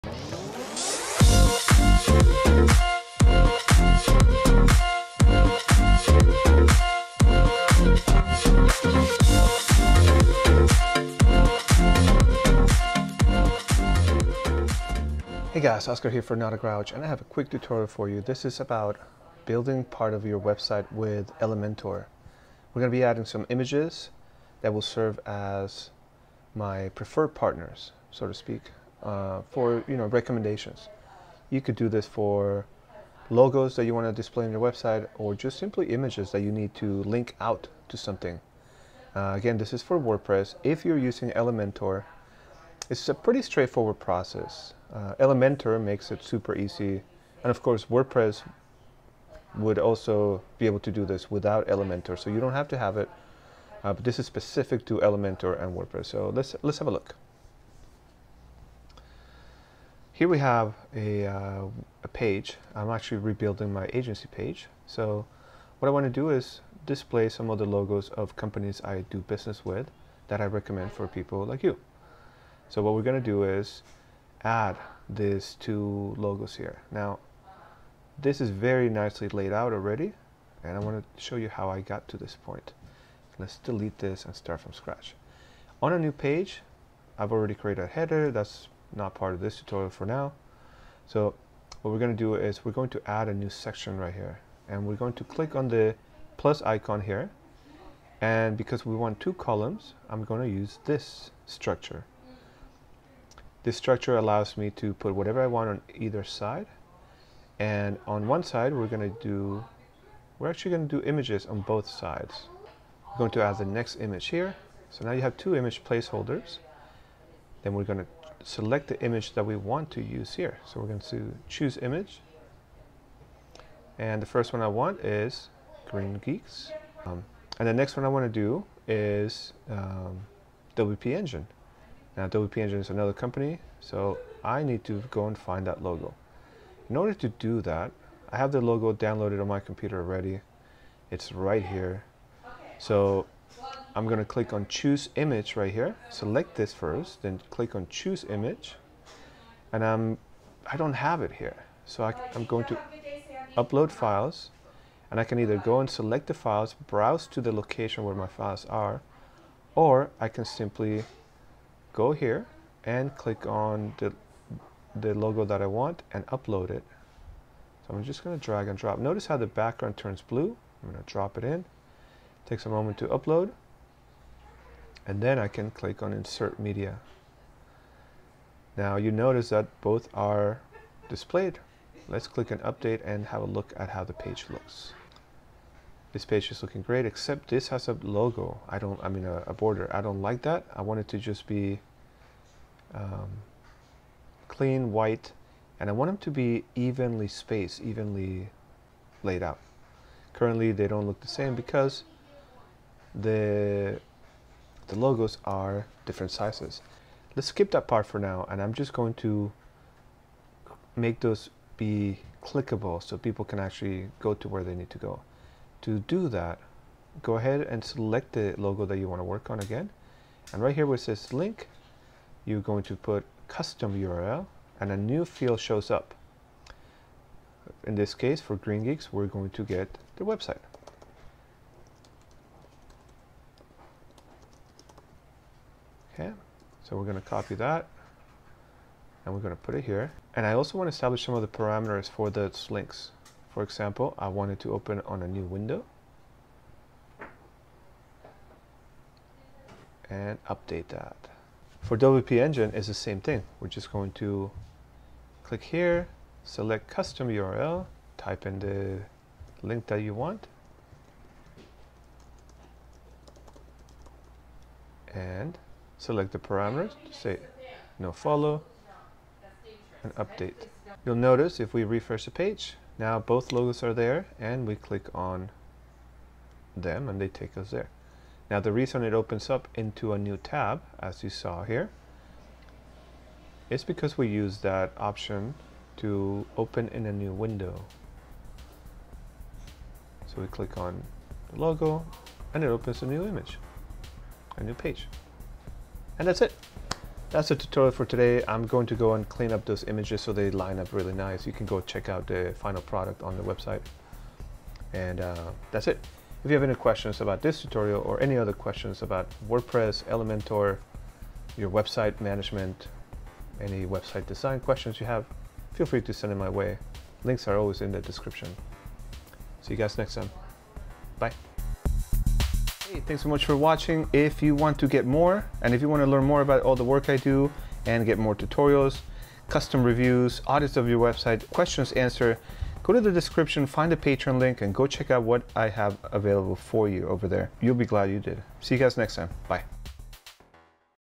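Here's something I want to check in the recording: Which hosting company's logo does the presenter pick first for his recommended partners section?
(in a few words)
Green Geeks.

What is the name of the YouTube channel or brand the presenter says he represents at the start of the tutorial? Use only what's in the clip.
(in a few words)
Not a Grouch.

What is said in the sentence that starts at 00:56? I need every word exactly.
So let's, let's have a look.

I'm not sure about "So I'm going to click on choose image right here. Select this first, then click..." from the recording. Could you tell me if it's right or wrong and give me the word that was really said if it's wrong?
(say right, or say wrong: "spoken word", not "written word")
right.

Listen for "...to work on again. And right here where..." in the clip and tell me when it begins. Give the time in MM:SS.
03:39.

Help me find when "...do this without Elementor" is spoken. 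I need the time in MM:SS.
00:50.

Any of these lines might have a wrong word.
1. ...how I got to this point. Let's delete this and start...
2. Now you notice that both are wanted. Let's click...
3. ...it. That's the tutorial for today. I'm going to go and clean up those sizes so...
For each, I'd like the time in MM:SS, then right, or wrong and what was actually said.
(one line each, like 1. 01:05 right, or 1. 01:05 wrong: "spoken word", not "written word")
1. 01:21 right
2. 02:58 wrong: "displayed", not "wanted"
3. 04:56 wrong: "images", not "sizes".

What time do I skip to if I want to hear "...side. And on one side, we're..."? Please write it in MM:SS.
01:46.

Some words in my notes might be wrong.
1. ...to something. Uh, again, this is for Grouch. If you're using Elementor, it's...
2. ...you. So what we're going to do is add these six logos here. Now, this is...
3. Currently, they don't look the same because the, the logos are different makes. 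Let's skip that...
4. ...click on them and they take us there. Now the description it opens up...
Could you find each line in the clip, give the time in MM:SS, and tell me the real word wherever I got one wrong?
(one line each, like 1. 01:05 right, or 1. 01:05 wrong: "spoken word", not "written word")
1. 00:37 wrong: "WordPress", not "Grouch"
2. 01:11 wrong: "two", not "six"
3. 03:20 wrong: "sizes", not "makes"
4. 04:34 wrong: "reason", not "description".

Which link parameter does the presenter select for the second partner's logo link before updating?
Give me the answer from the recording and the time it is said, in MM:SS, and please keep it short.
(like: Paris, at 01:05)
No follow, at 04:27.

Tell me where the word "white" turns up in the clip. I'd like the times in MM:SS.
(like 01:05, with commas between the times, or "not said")
03:14.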